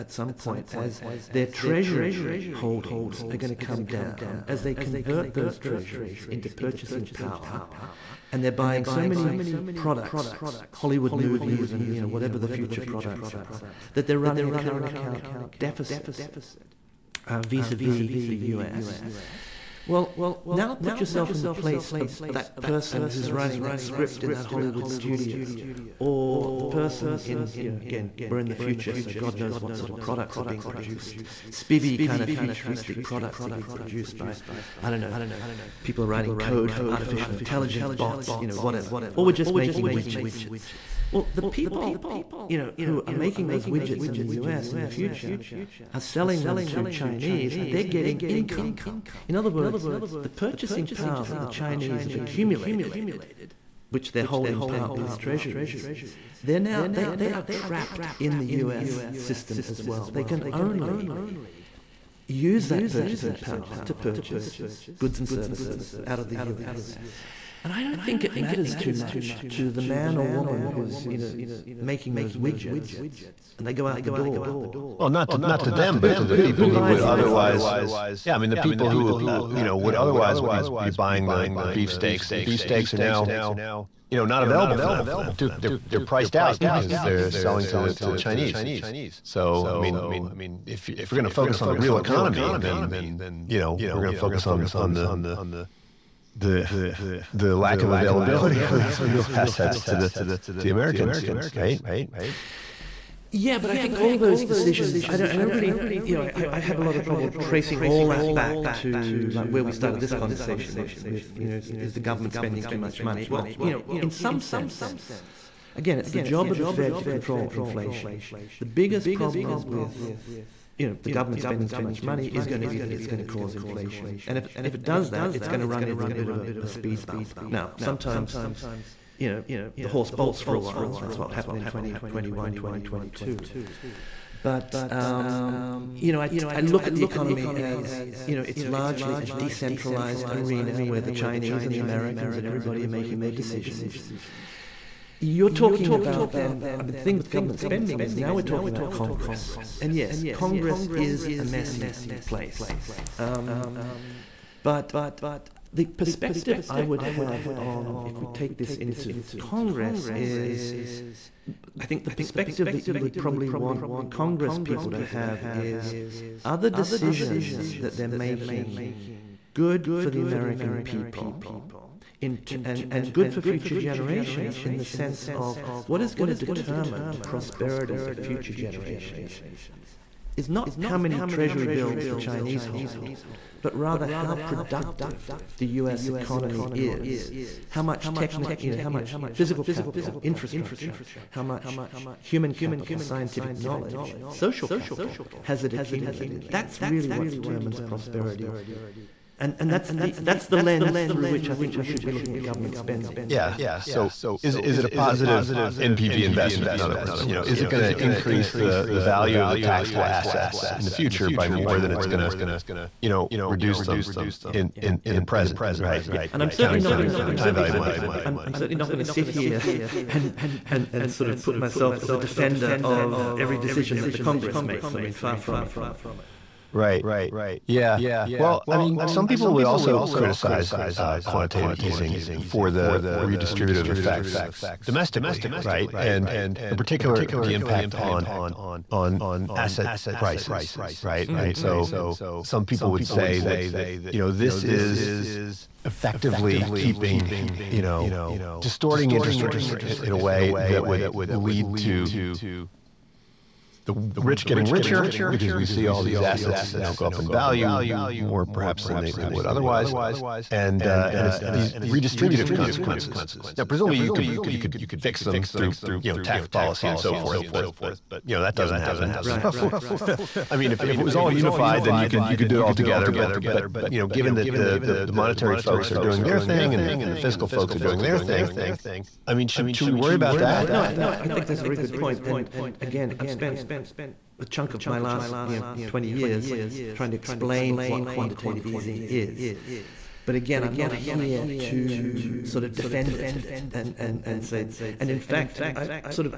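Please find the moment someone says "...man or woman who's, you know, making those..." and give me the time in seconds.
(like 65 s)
69 s.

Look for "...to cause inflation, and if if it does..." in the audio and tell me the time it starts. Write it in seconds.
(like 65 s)
123 s.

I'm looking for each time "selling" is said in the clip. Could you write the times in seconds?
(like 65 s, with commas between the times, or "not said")
45 s, 87 s.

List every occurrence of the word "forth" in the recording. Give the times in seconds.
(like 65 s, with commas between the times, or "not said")
267 s.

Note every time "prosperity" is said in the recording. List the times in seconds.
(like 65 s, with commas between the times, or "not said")
177 s, 197 s.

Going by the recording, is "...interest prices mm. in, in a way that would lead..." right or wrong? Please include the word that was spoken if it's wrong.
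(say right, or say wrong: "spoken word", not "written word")
wrong: "rates", not "prices".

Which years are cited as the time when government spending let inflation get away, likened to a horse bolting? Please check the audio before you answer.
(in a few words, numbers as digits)
2021, 2022.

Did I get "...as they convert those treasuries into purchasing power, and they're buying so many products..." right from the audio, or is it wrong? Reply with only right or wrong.
right.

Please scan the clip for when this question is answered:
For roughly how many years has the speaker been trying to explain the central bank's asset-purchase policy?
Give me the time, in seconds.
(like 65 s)
285 s.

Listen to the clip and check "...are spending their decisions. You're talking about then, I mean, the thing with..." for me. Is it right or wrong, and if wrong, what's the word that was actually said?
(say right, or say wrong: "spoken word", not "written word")
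wrong: "making", not "spending".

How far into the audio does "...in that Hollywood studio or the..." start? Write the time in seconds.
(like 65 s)
24 s.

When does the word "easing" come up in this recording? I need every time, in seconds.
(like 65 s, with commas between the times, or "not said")
231 s, 288 s.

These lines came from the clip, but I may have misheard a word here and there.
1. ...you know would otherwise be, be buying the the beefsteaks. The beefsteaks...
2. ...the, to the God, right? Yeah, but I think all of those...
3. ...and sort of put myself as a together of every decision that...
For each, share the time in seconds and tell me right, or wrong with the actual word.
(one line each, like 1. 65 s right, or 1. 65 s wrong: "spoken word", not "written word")
1. 79 s right
2. 99 s wrong: "Americans", not "God"
3. 220 s wrong: "defender", not "together".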